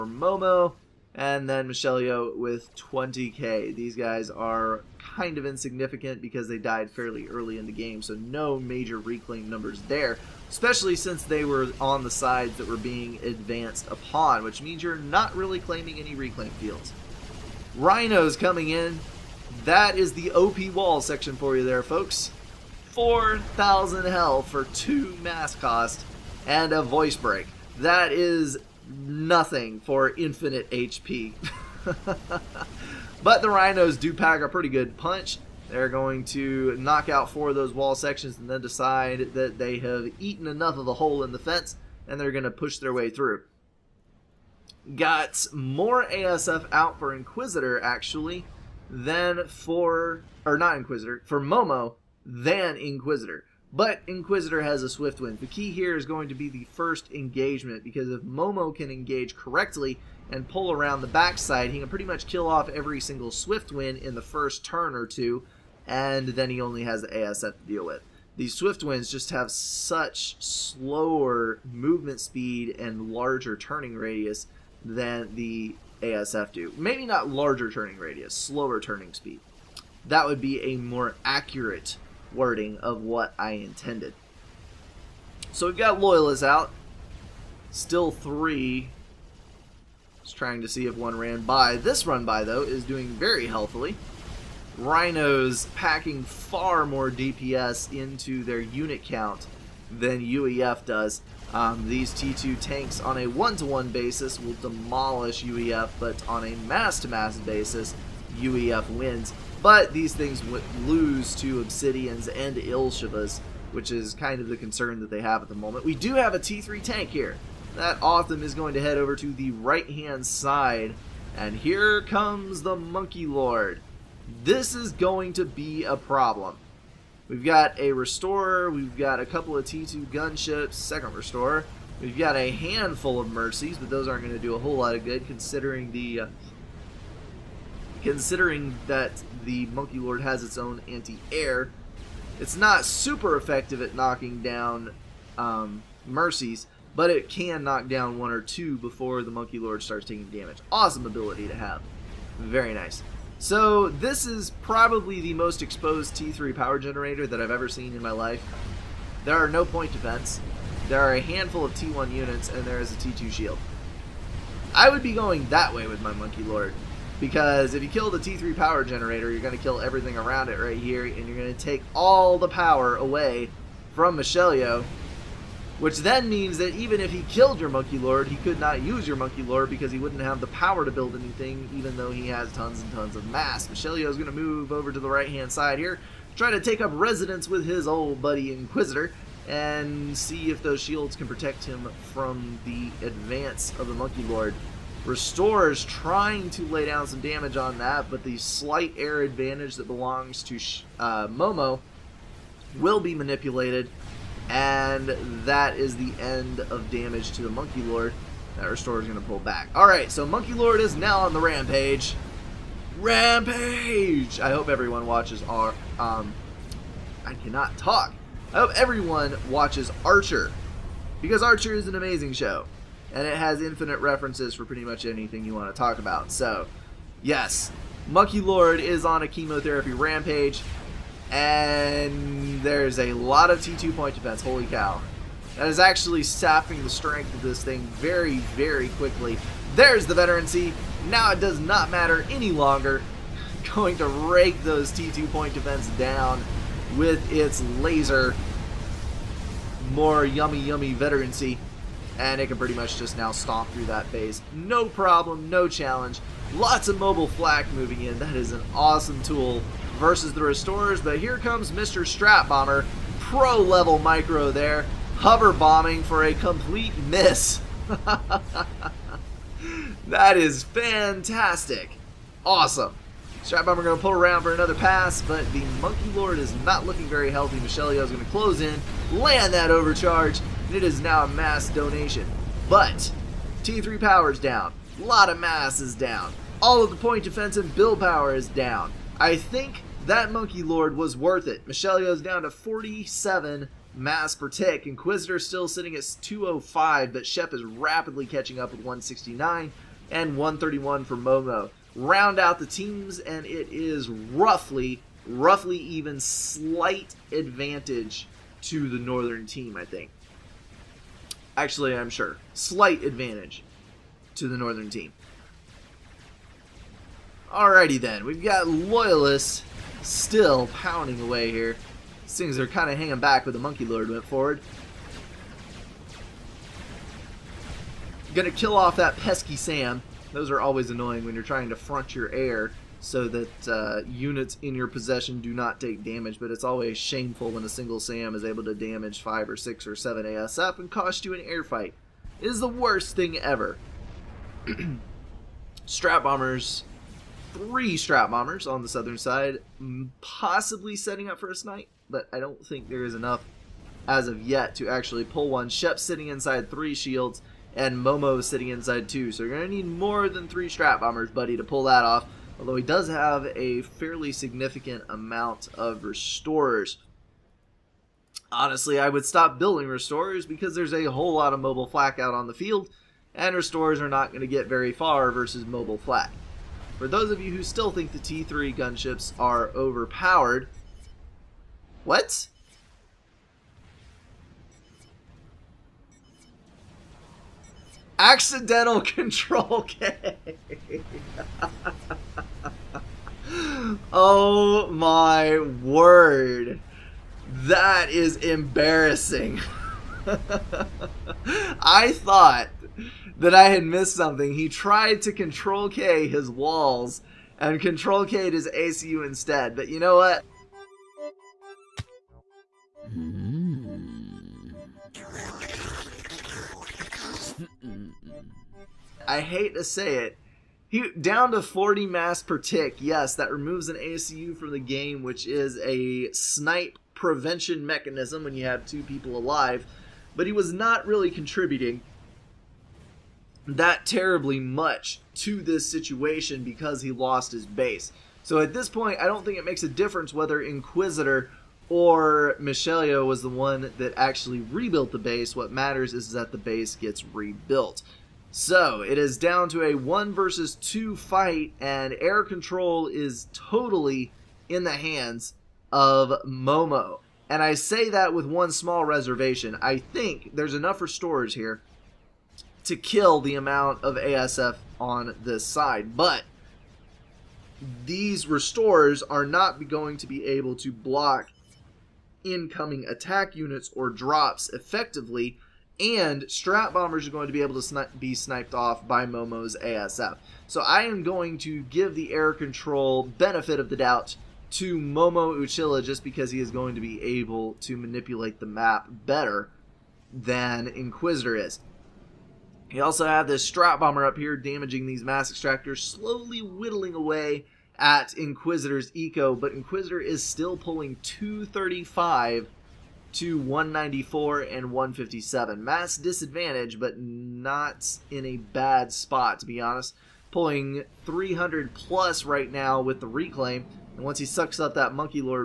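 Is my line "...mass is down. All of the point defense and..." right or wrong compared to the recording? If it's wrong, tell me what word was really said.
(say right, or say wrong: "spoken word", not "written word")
right.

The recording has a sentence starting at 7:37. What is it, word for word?
And I say that with one small reservation.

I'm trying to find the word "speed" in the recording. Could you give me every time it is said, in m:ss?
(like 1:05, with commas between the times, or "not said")
1:12, 1:19.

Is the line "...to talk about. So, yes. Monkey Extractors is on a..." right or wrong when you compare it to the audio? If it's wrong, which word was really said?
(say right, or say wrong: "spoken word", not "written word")
wrong: "Lord", not "Extractors".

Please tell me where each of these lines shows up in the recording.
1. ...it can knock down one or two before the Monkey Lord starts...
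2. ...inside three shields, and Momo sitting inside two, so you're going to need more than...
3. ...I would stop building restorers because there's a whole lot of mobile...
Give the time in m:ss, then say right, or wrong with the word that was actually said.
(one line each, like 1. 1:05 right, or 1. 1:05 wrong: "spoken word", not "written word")
1. 2:27 right
2. 5:56 right
3. 6:08 right.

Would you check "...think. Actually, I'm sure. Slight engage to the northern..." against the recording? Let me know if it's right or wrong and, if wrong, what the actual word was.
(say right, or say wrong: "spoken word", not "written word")
wrong: "advantage", not "engage".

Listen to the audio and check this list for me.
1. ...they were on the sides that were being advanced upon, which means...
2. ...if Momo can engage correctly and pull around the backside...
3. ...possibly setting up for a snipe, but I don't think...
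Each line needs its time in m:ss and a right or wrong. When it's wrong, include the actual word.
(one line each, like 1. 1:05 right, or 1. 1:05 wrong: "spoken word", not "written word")
1. 0:11 right
2. 0:58 right
3. 5:50 right.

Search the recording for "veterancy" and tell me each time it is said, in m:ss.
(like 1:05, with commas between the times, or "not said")
4:00, 4:10.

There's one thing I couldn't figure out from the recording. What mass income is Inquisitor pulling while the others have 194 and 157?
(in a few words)
235.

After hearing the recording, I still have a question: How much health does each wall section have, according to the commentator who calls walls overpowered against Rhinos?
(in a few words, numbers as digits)
4,000.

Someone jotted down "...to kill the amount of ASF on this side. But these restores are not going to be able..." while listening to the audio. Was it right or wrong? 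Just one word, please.
right.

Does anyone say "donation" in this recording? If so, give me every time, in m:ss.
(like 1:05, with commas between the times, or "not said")
4:41.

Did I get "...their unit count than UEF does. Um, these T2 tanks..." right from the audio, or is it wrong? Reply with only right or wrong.
right.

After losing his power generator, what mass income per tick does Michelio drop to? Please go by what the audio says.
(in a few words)
47.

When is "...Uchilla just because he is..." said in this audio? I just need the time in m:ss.
8:05.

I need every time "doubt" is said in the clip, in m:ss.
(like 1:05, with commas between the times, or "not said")
8:03.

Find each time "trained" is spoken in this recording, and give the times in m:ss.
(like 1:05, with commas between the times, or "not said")
not said.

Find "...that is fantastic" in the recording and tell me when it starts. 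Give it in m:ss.
4:30.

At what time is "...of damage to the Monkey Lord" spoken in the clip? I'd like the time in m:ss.
3:26.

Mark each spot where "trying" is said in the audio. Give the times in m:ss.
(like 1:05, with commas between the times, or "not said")
1:30, 3:15, 5:31.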